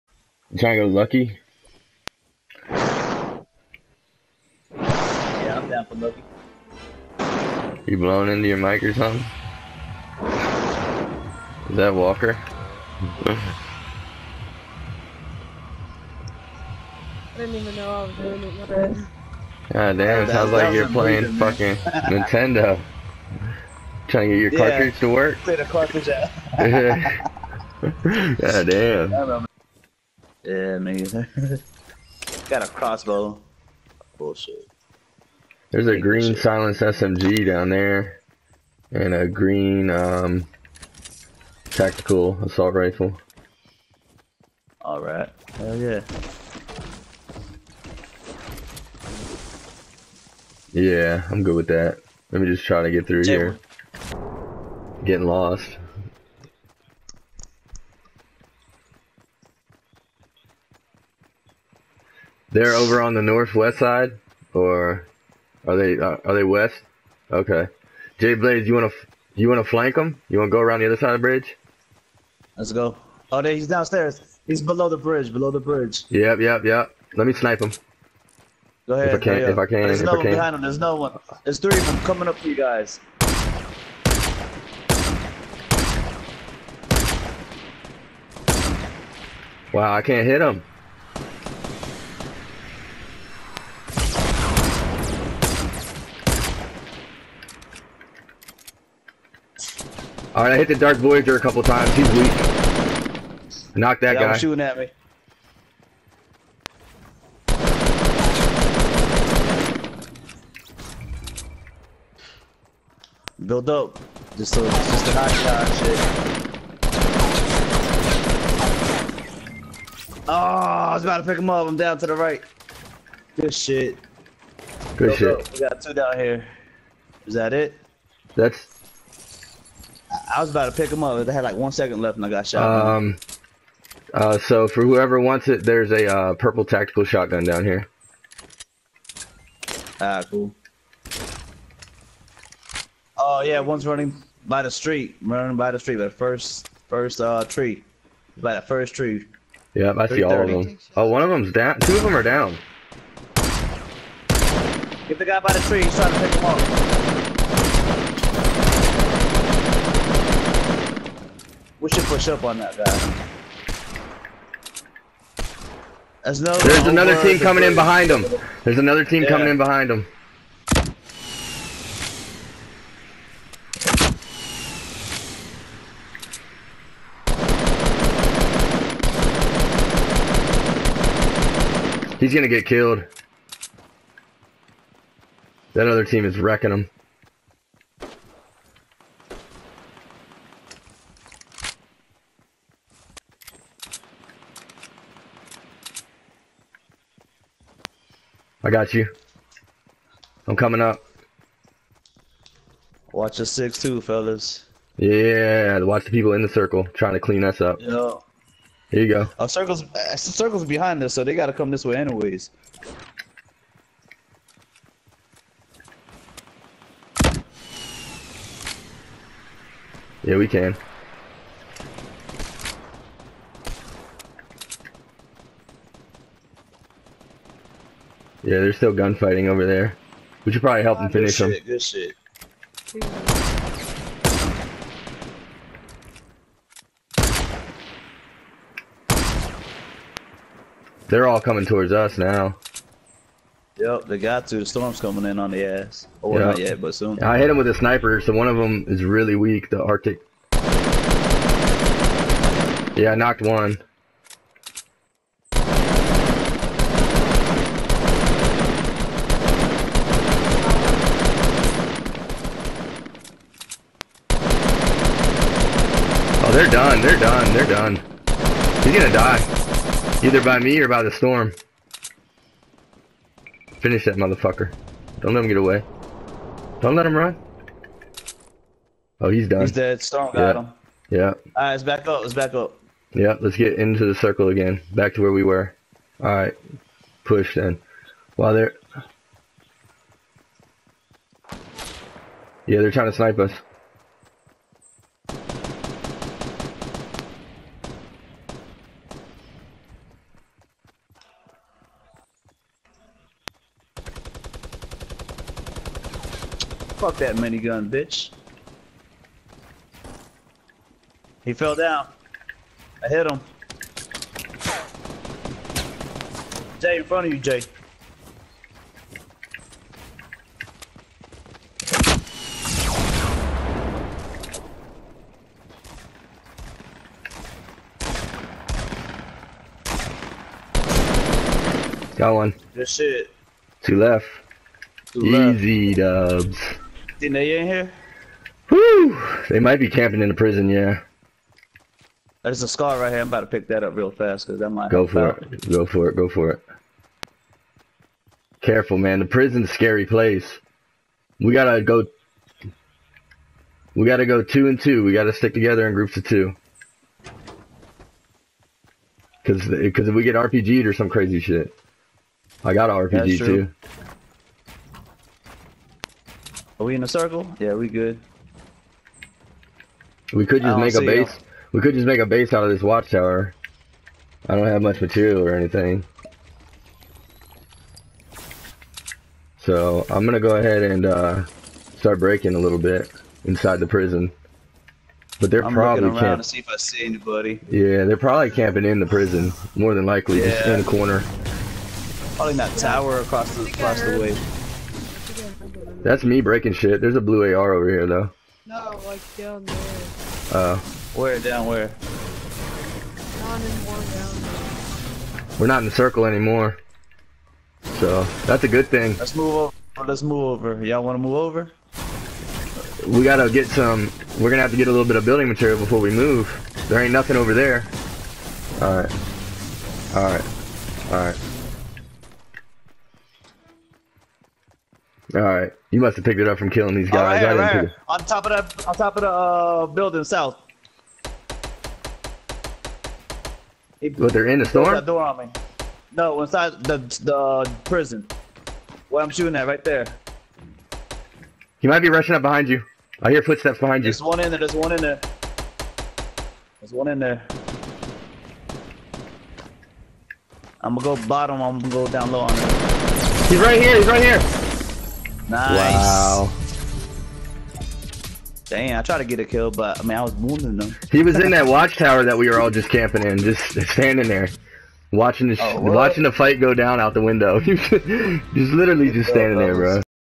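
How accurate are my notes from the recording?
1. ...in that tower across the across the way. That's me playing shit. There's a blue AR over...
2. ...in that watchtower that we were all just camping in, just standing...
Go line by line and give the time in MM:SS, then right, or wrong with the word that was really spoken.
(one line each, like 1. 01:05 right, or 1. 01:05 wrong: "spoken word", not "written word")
1. 06:32 wrong: "breaking", not "playing"
2. 07:41 right.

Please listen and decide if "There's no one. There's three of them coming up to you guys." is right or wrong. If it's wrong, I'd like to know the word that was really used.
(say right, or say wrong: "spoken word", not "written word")
right.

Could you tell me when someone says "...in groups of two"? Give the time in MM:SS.
05:55.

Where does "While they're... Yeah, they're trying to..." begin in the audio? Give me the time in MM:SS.
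04:48.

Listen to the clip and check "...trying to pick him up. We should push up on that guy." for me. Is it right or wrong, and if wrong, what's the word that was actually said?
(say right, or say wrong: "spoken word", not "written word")
right.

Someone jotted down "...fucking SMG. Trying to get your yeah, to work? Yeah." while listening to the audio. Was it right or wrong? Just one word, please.
wrong.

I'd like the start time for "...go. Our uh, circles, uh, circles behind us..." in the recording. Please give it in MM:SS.
03:29.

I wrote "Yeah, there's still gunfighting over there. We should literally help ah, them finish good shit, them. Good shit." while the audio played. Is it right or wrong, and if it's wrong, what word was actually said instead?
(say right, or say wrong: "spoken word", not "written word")
wrong: "probably", not "literally".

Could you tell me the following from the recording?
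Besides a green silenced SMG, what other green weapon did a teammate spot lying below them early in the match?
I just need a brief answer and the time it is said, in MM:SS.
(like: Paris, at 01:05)
Tactical assault rifle, at 00:41.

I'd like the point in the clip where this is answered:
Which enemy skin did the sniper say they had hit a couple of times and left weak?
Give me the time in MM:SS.
01:40.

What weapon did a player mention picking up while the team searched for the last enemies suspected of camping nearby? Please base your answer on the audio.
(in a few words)
Scar.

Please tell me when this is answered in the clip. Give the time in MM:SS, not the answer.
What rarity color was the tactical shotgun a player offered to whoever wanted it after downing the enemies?
02:16.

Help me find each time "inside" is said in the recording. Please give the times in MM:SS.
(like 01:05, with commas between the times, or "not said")
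06:23, 07:16.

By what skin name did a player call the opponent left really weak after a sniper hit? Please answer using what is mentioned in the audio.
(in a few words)
Arctic.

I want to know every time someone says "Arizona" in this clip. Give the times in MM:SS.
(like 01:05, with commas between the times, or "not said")
not said.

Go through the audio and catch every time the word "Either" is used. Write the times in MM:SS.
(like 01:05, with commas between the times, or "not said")
04:30.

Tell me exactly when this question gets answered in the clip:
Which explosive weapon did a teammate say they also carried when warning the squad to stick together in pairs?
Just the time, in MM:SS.
06:02.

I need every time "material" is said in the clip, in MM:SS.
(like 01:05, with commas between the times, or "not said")
06:14, 06:55.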